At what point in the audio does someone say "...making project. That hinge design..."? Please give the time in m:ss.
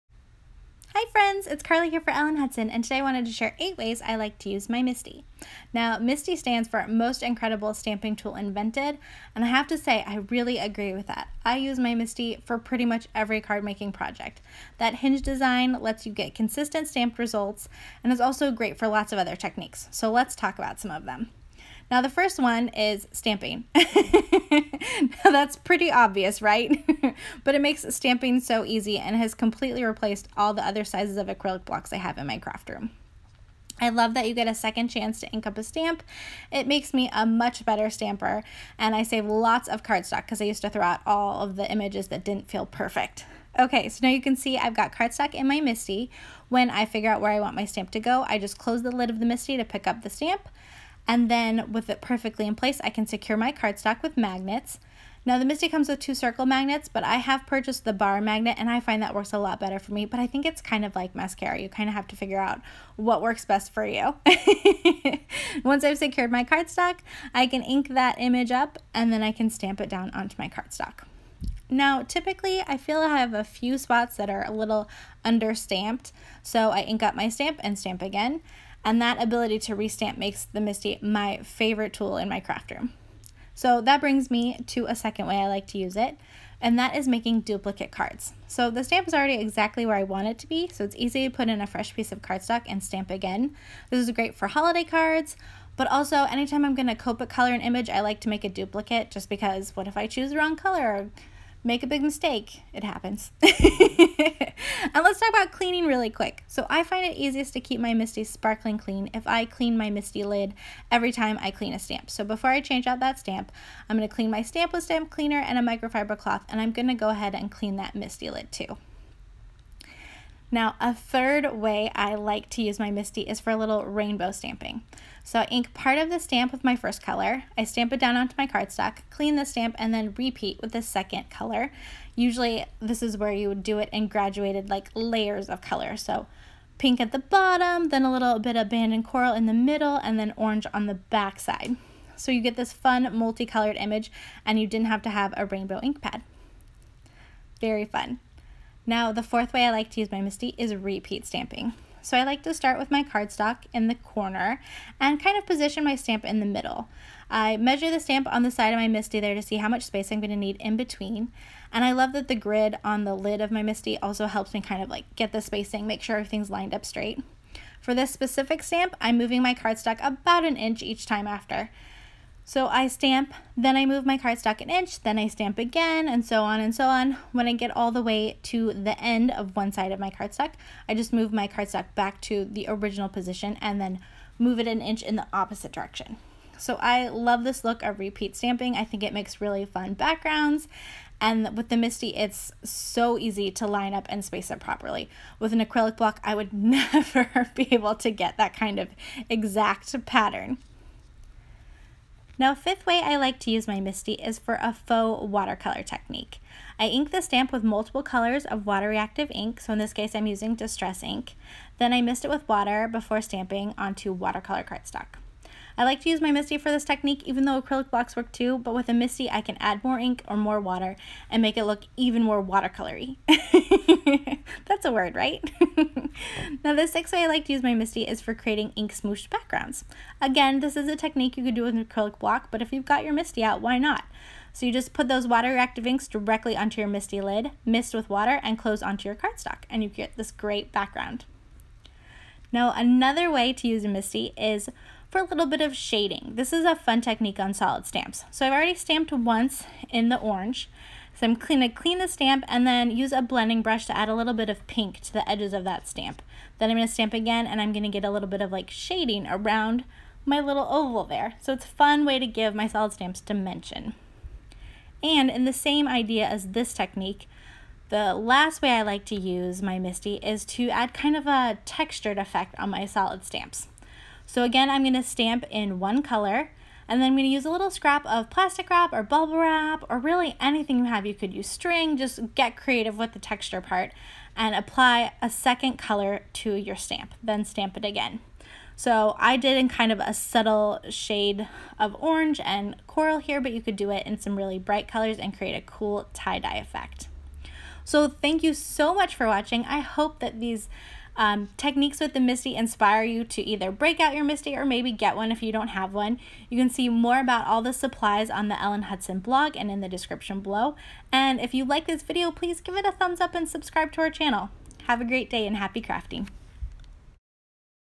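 0:13.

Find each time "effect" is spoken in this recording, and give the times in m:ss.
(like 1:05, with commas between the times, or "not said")
4:32, 4:56.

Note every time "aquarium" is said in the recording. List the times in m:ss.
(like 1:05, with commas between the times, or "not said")
not said.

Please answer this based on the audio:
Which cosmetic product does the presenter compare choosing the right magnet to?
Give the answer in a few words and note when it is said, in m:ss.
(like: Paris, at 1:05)
mascara, at 1:01.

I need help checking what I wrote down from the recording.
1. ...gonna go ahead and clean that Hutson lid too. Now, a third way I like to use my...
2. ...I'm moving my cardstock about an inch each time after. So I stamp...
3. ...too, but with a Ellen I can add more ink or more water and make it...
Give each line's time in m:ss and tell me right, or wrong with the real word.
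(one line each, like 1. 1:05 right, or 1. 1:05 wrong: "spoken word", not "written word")
1. 1:56 wrong: "MISTI", not "Hutson"
2. 2:48 right
3. 3:38 wrong: "MISTI", not "Ellen".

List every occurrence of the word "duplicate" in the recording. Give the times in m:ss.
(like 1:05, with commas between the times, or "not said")
1:27, 1:38.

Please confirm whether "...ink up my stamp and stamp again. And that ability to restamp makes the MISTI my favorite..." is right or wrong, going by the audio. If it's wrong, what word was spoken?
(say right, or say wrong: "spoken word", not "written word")
right.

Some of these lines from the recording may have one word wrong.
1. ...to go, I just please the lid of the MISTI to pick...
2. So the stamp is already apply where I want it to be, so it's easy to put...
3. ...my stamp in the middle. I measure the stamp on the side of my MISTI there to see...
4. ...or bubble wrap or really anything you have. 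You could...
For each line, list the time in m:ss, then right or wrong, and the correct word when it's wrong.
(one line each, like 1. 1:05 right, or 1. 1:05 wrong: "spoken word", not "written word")
1. 0:47 wrong: "close", not "please"
2. 1:28 wrong: "exactly", not "apply"
3. 2:35 right
4. 4:38 right.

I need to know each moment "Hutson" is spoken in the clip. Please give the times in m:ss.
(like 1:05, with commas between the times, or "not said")
0:02, 5:08.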